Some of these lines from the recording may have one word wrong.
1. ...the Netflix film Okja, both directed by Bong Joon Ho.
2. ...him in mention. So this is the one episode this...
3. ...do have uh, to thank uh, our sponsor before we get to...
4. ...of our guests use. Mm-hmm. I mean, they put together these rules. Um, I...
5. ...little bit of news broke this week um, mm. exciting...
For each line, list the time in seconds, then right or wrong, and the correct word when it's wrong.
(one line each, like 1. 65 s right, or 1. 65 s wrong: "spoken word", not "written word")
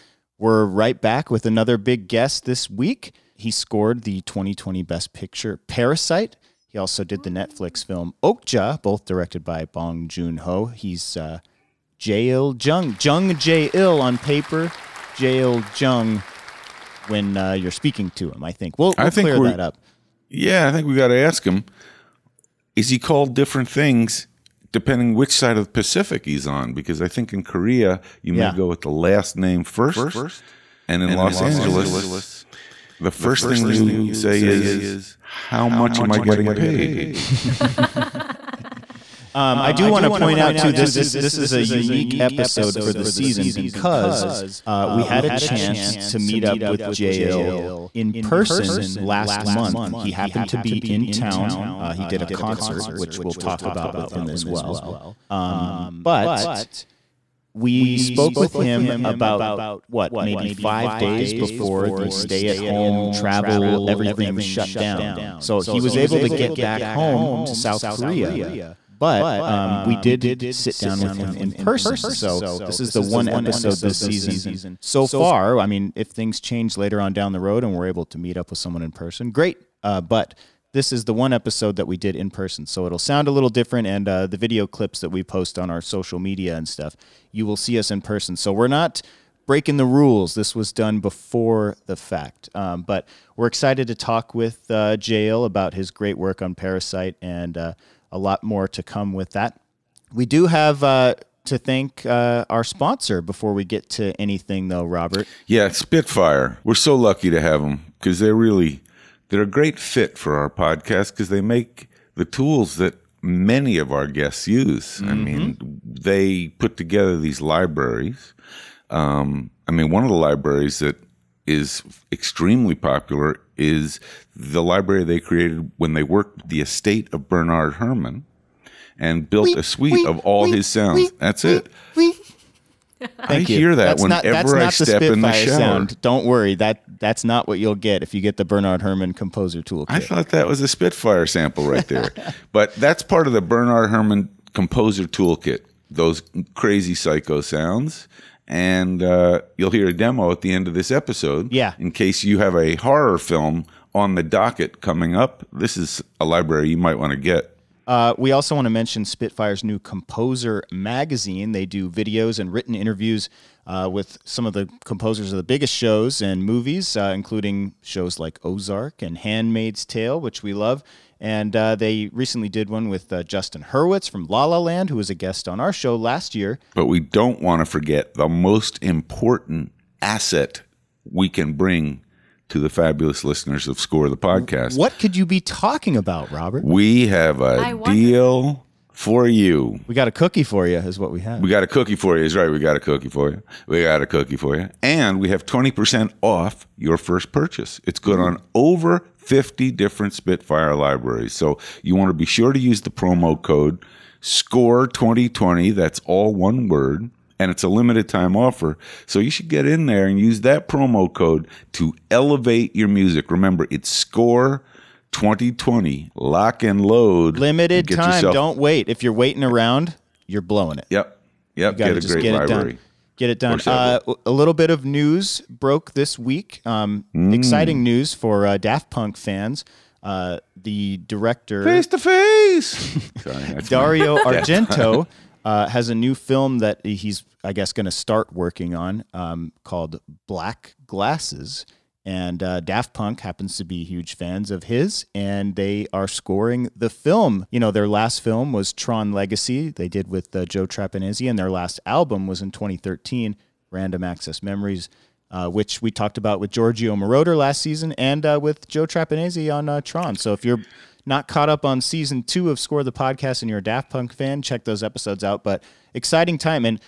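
1. 7 s right
2. 71 s wrong: "person", not "mention"
3. 100 s right
4. 113 s wrong: "libraries", not "rules"
5. 224 s right.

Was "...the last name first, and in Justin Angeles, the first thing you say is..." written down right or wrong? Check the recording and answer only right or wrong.
wrong.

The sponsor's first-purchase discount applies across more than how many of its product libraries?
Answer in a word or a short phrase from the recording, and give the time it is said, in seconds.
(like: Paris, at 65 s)
50, at 198 s.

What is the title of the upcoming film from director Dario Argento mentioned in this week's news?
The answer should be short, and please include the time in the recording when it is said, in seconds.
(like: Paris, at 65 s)
Black Glasses, at 240 s.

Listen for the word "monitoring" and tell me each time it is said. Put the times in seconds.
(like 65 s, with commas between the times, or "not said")
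not said.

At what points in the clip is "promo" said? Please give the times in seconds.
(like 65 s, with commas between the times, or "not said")
202 s, 210 s.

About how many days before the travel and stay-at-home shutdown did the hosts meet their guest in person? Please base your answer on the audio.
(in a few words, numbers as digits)
5.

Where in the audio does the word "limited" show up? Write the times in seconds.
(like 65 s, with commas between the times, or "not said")
207 s, 217 s.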